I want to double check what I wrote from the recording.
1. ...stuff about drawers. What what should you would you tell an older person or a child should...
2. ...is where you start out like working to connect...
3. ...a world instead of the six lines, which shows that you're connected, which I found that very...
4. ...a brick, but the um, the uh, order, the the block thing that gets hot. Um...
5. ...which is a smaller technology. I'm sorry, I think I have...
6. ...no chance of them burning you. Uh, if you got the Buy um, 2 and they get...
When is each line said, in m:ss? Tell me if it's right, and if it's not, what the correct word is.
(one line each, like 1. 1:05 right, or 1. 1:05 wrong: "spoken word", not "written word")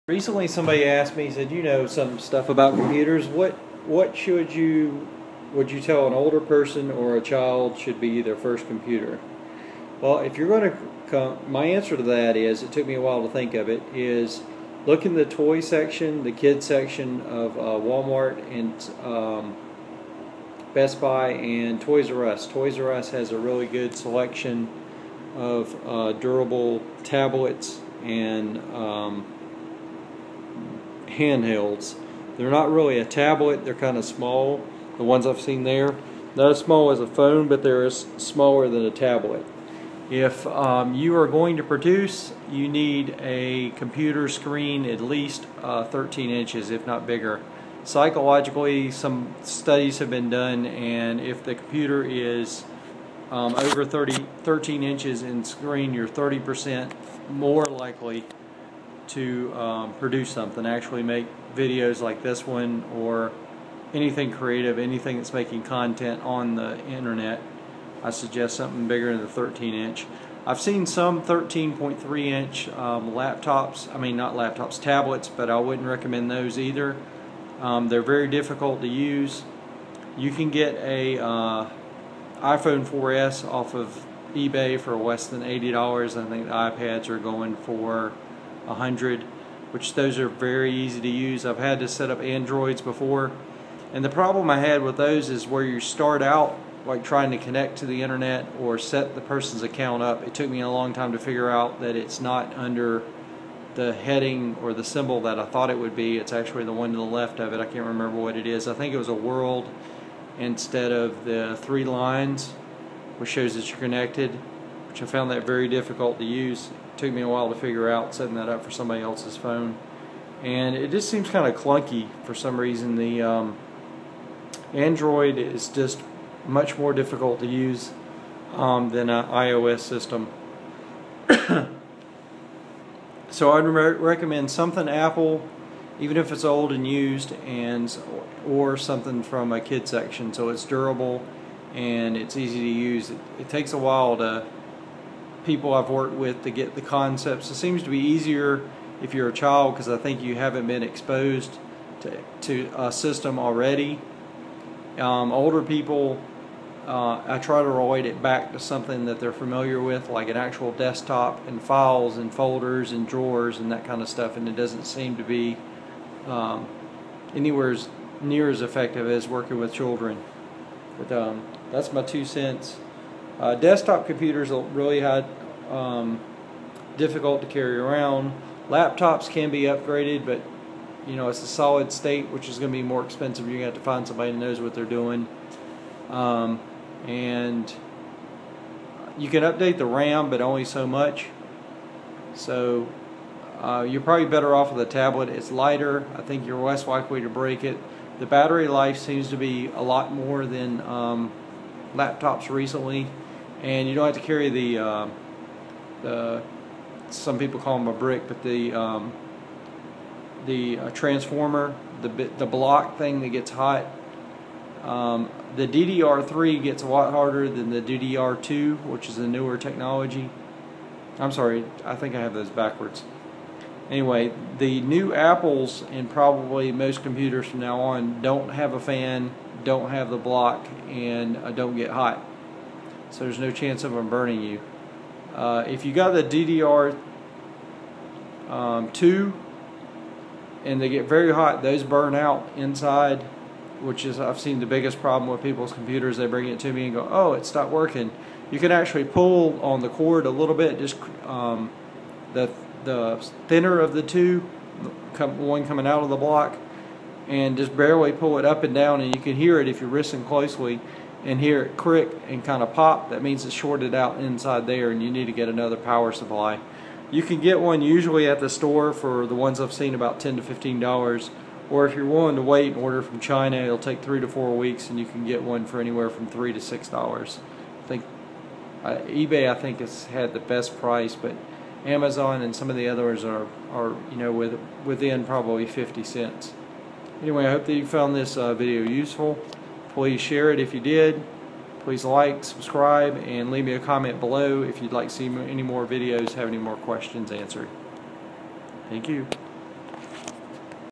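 1. 0:02 wrong: "computers", not "drawers"
2. 1:35 wrong: "trying", not "working"
3. 1:49 wrong: "three", not "six"
4. 3:27 wrong: "transformer", not "order"
5. 3:38 wrong: "newer", not "smaller"
6. 3:53 wrong: "DDR", not "Buy".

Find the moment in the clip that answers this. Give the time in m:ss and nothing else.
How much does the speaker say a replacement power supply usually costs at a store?
4:30.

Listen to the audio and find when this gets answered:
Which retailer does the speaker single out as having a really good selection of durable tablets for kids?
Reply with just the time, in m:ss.
0:22.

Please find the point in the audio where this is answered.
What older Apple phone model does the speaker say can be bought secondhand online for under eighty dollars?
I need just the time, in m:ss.
1:22.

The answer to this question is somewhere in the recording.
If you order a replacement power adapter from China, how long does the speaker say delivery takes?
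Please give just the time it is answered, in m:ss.
4:34.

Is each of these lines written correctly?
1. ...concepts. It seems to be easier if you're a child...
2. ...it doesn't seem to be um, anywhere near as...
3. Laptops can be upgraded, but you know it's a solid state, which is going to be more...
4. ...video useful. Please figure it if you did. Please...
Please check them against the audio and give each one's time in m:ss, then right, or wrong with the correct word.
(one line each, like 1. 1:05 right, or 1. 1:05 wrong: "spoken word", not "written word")
1. 2:26 right
2. 2:44 right
3. 2:58 right
4. 4:48 wrong: "share", not "figure".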